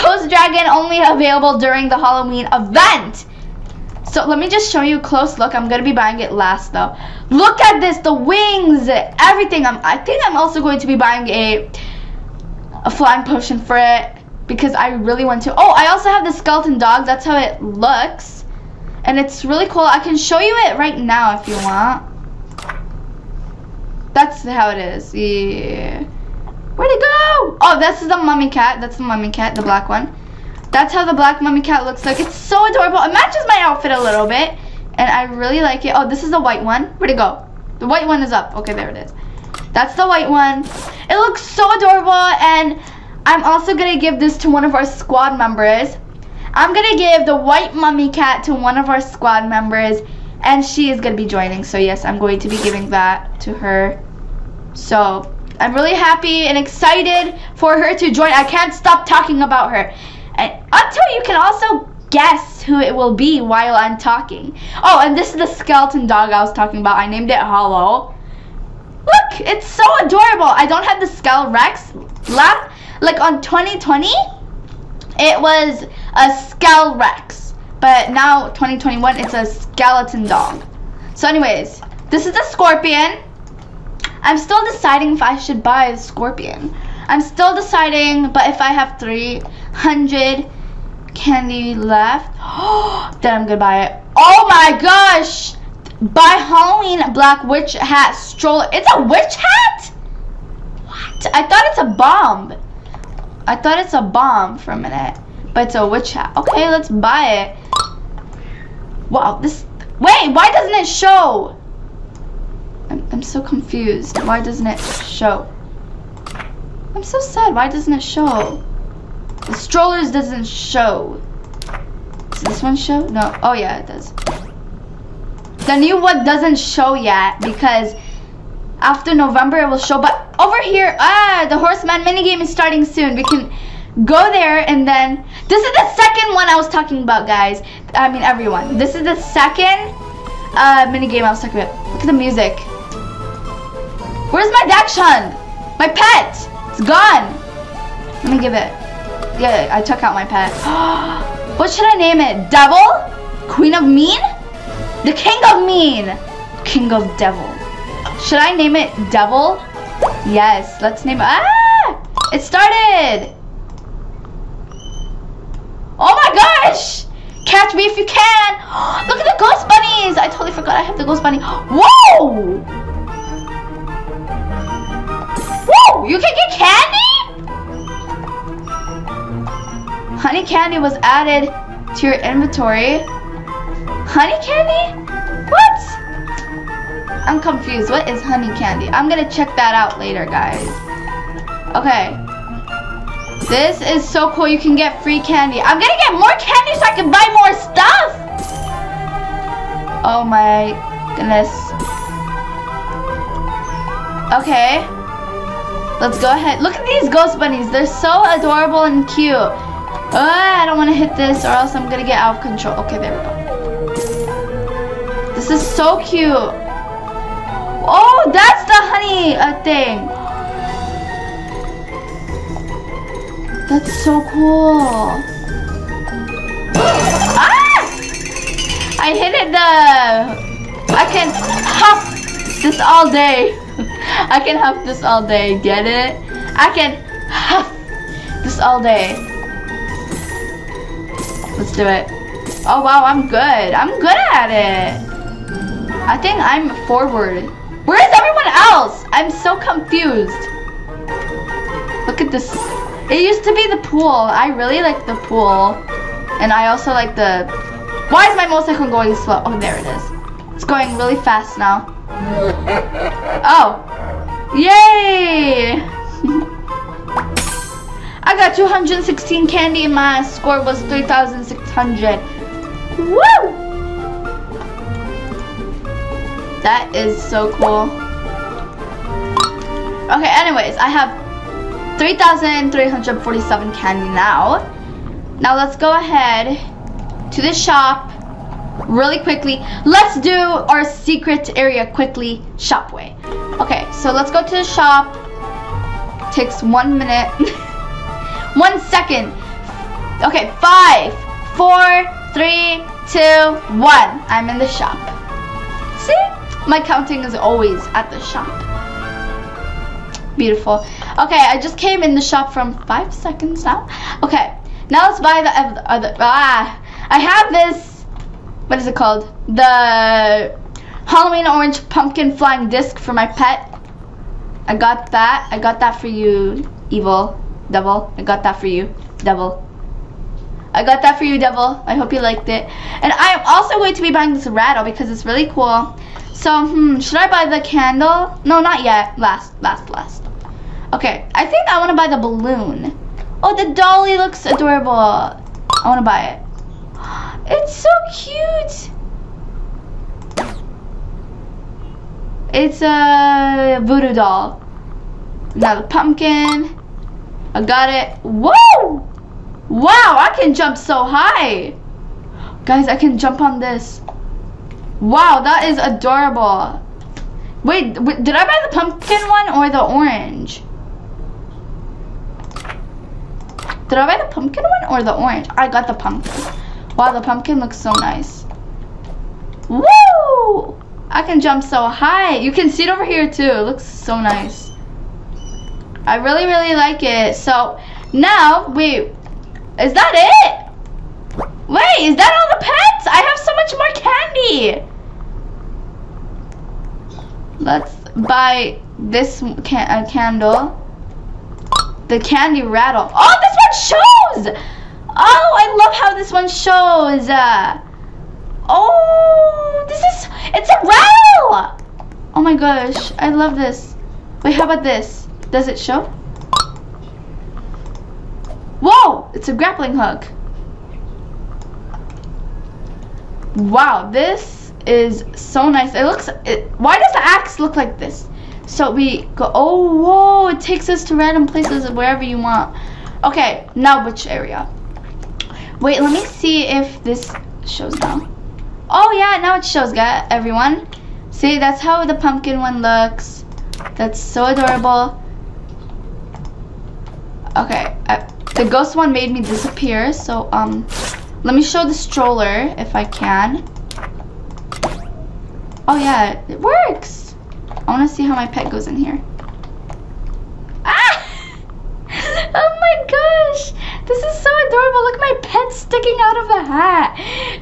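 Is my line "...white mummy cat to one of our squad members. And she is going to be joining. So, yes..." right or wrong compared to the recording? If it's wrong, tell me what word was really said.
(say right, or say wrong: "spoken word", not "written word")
right.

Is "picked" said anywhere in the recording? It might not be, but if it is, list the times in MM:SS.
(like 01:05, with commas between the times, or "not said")
not said.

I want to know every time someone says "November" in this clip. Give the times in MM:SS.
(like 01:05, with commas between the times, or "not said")
02:09.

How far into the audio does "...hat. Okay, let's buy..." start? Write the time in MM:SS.
01:46.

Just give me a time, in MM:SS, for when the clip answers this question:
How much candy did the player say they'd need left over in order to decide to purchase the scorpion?
01:28.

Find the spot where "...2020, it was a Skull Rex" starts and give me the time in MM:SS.
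01:13.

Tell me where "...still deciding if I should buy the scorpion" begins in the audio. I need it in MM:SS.
01:24.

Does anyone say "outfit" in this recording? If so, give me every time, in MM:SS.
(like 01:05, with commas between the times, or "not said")
00:33.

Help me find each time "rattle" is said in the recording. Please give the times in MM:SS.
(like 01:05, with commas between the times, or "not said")
05:34, 06:42.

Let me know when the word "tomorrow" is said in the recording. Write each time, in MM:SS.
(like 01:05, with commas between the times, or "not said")
not said.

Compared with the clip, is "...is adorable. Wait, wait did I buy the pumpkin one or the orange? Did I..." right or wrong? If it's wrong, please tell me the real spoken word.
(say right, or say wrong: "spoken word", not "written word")
right.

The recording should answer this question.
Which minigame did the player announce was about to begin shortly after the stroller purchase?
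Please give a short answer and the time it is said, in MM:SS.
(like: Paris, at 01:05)
Horseman, at 02:11.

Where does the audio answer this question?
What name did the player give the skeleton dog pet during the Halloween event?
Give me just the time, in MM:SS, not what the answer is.
01:06.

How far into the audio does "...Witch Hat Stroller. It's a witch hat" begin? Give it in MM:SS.
01:37.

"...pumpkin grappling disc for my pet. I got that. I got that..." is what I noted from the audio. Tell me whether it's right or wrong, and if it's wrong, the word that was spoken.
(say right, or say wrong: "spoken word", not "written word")
wrong: "flying", not "grappling".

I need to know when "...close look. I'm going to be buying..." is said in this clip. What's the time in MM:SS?
00:05.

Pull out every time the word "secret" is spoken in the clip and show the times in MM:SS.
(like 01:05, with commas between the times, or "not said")
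04:50.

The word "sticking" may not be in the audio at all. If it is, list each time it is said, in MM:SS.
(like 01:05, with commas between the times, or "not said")
07:45.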